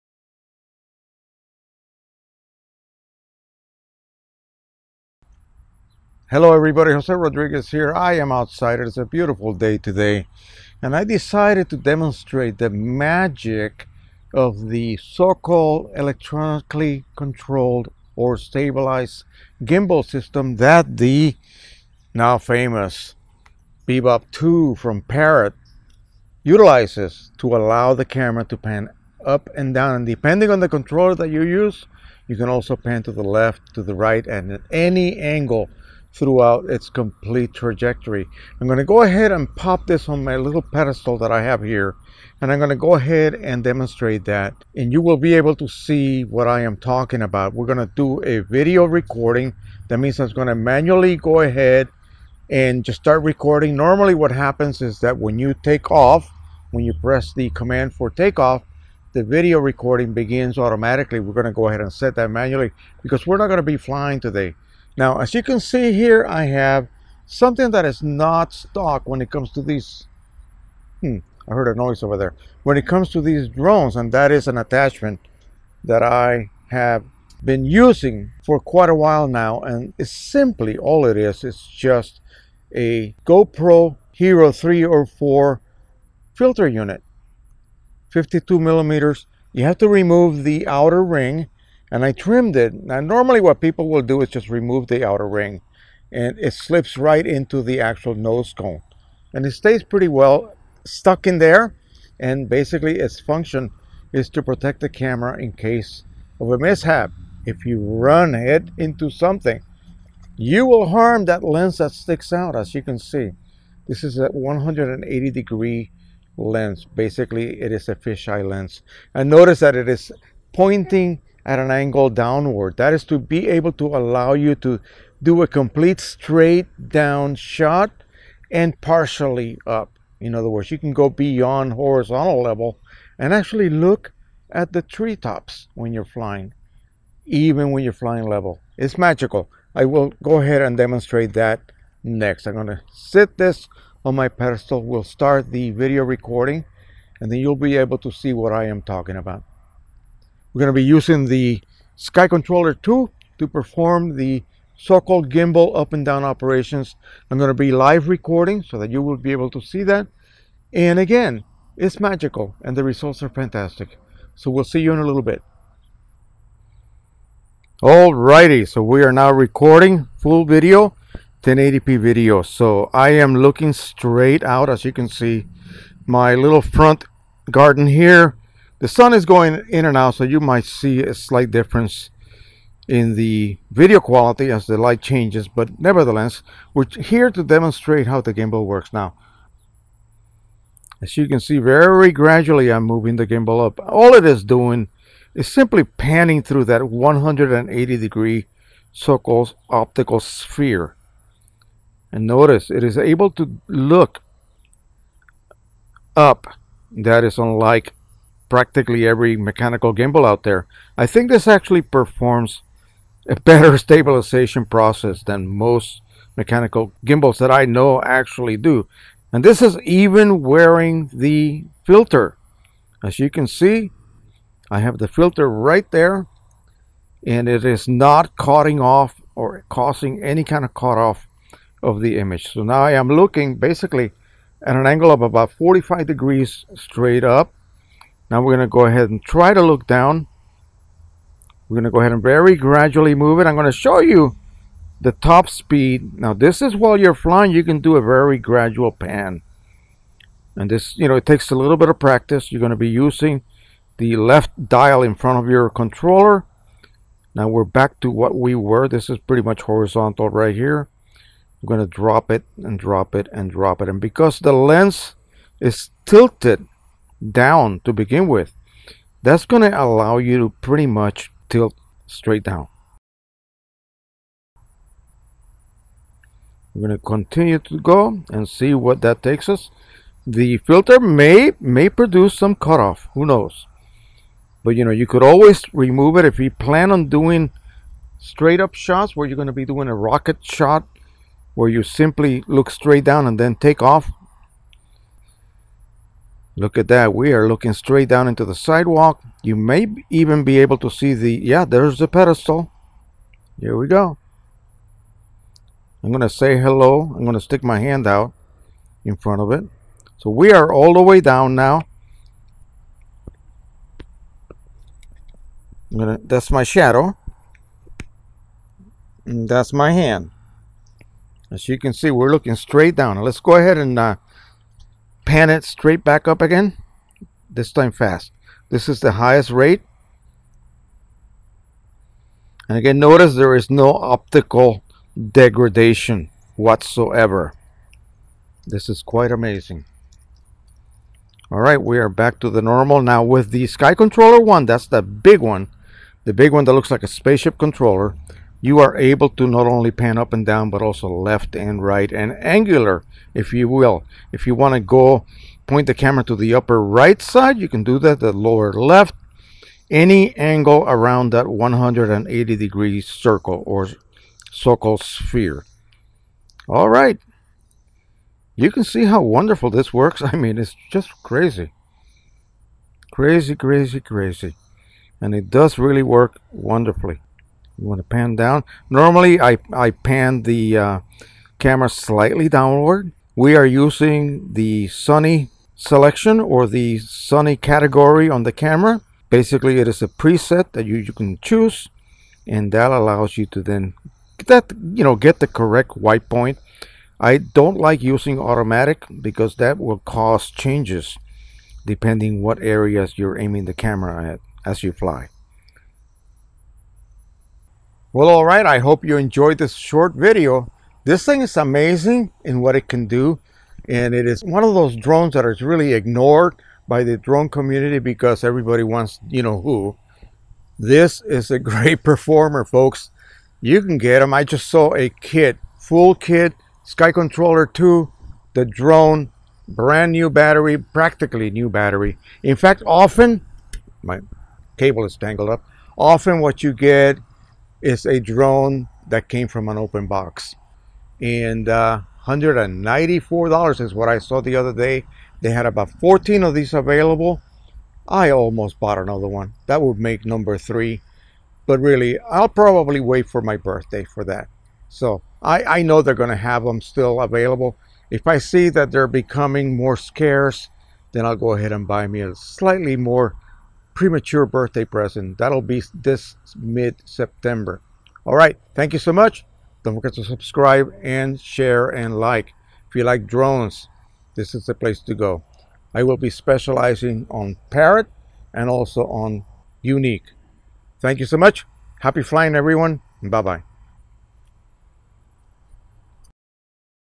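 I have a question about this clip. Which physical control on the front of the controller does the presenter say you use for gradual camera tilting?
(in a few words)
left dial.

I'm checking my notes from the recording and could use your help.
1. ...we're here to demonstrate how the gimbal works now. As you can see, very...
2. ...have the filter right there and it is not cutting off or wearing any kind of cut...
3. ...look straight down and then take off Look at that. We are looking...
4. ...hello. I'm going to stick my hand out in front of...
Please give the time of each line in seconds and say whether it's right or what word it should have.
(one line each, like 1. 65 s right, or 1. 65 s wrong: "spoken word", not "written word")
1. 186 s right
2. 224 s wrong: "causing", not "wearing"
3. 292 s right
4. 306 s right.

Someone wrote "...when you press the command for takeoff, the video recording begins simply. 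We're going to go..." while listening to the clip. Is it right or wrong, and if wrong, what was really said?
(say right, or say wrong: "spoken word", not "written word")
wrong: "automatically", not "simply".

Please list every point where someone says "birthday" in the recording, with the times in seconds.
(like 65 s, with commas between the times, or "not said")
453 s, 464 s.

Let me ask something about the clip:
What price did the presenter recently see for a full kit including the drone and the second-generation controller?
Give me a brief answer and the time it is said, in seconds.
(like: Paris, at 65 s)
$194, at 442 s.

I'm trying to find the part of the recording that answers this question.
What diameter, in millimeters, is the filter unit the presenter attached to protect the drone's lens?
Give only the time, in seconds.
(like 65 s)
88 s.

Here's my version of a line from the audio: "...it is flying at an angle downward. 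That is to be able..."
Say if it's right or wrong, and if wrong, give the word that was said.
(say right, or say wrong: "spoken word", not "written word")
wrong: "pointing", not "flying".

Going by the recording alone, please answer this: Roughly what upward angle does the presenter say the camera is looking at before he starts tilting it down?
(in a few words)
45 degrees.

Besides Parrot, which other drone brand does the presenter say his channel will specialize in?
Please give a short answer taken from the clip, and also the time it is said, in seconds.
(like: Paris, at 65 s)
Yuneec, at 479 s.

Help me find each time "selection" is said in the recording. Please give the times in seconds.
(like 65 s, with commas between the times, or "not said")
385 s.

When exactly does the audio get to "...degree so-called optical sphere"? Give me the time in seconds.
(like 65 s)
197 s.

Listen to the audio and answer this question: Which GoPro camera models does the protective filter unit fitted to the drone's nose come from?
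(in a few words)
GoPro Hero 3 or 4.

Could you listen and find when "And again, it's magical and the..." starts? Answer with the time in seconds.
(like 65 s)
160 s.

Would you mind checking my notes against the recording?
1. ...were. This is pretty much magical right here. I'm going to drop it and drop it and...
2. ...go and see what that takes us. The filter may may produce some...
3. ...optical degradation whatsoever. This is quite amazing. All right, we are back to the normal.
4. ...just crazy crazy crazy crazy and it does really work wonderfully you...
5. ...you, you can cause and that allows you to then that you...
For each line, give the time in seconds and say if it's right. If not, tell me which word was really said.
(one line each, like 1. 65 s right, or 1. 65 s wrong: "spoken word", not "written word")
1. 258 s wrong: "horizontal", not "magical"
2. 277 s right
3. 333 s right
4. 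370 s right
5. 390 s wrong: "choose", not "cause".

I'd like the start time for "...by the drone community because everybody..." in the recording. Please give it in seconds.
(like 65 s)
416 s.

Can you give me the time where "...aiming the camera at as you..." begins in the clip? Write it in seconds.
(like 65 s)
403 s.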